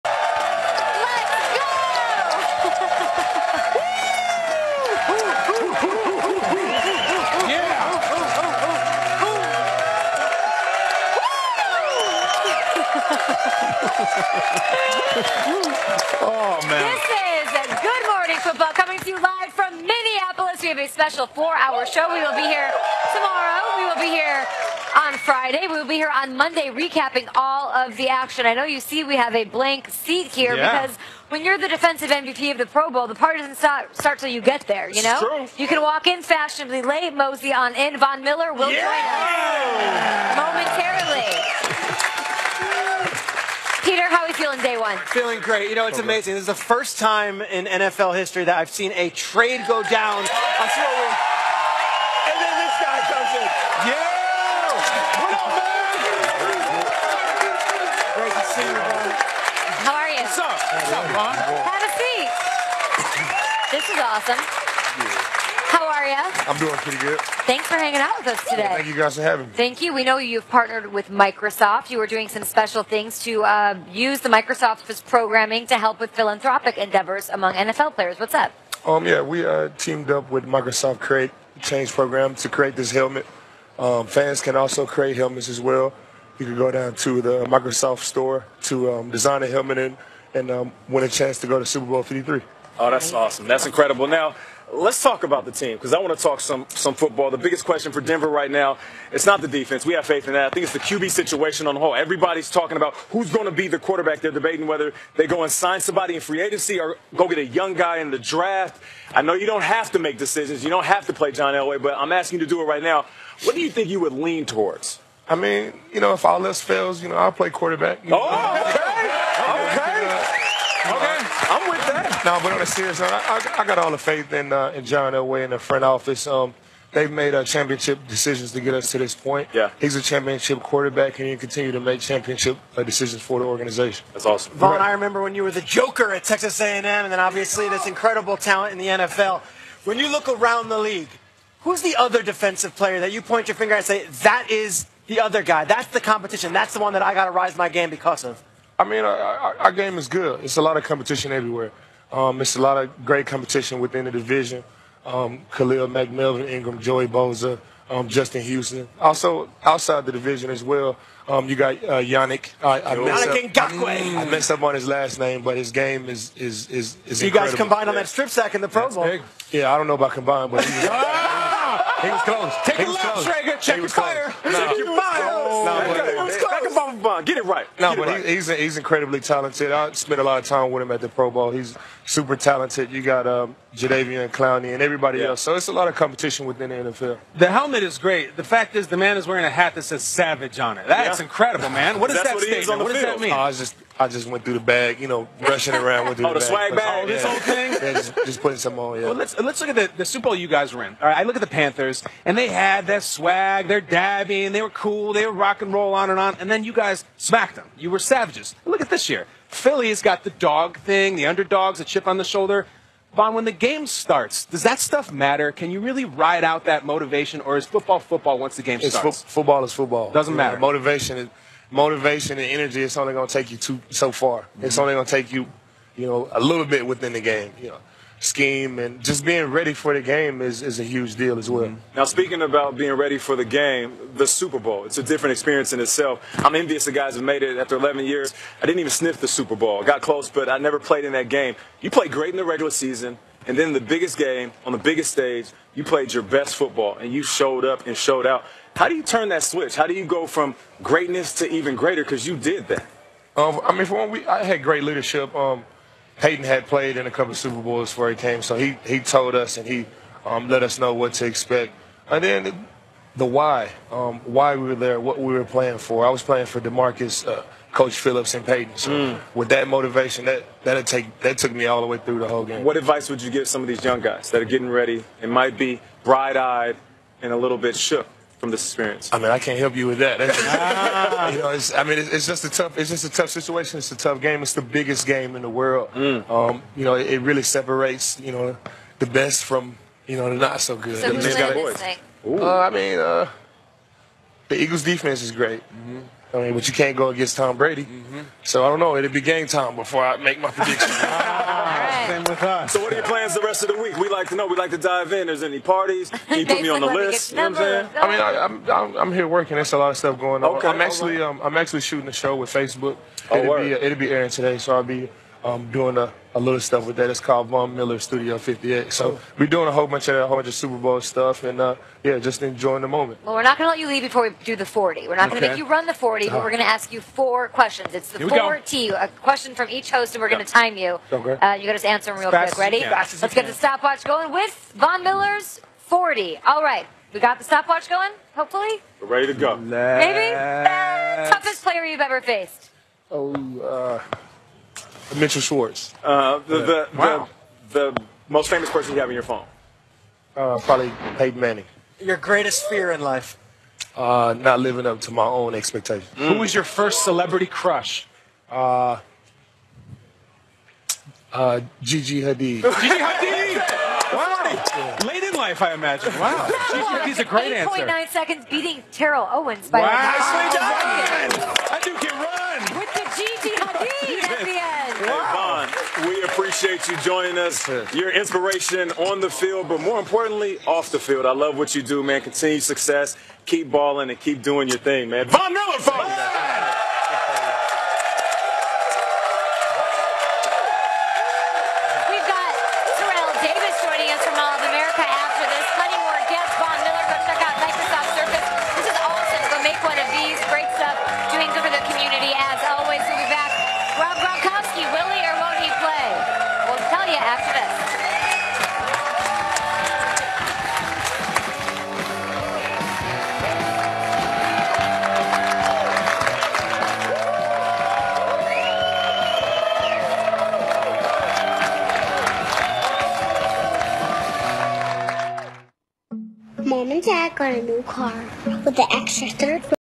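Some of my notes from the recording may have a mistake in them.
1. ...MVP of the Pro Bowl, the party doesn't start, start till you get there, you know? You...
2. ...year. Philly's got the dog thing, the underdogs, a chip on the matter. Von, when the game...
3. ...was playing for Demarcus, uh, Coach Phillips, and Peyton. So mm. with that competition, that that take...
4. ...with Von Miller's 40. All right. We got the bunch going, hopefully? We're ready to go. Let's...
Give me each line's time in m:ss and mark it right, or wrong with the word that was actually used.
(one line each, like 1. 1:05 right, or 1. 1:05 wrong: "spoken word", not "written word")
1. 0:32 right
2. 3:29 wrong: "shoulder", not "matter"
3. 4:26 wrong: "motivation", not "competition"
4. 5:34 wrong: "stopwatch", not "bunch".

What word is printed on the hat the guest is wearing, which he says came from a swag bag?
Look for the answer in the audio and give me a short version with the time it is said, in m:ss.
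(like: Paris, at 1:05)
Savage, at 3:10.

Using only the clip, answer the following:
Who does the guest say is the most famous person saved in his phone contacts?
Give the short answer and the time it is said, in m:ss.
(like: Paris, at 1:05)
Peyton Manning, at 5:51.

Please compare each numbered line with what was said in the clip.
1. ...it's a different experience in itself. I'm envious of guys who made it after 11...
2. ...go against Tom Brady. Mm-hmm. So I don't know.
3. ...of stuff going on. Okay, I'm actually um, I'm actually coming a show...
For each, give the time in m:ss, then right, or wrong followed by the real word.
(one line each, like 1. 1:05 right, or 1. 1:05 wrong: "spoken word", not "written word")
1. 3:54 right
2. 4:56 right
3. 5:09 wrong: "shooting", not "coming".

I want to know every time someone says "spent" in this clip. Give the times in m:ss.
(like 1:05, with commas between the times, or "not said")
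2:59.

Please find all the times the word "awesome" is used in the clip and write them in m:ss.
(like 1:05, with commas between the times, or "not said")
1:04, 1:33, 2:14.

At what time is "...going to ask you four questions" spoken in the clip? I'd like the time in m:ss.
5:26.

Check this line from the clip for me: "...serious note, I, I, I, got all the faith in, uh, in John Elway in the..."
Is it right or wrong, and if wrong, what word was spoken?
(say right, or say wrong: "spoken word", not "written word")
right.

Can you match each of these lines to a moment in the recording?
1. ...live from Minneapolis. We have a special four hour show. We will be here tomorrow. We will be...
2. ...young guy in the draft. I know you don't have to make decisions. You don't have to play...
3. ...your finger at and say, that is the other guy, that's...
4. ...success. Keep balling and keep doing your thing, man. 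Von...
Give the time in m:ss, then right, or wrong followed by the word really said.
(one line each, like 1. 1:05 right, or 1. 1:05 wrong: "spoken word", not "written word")
1. 0:19 right
2. 1:47 right
3. 2:23 right
4. 6:22 right.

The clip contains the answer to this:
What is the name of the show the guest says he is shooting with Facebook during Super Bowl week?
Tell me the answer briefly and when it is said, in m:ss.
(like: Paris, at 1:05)
Von Miller Studio 58, at 5:17.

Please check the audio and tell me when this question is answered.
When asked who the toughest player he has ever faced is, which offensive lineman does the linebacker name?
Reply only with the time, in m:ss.
5:45.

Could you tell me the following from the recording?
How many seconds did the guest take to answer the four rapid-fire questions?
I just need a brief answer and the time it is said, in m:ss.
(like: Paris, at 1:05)
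8.9 seconds, at 6:07.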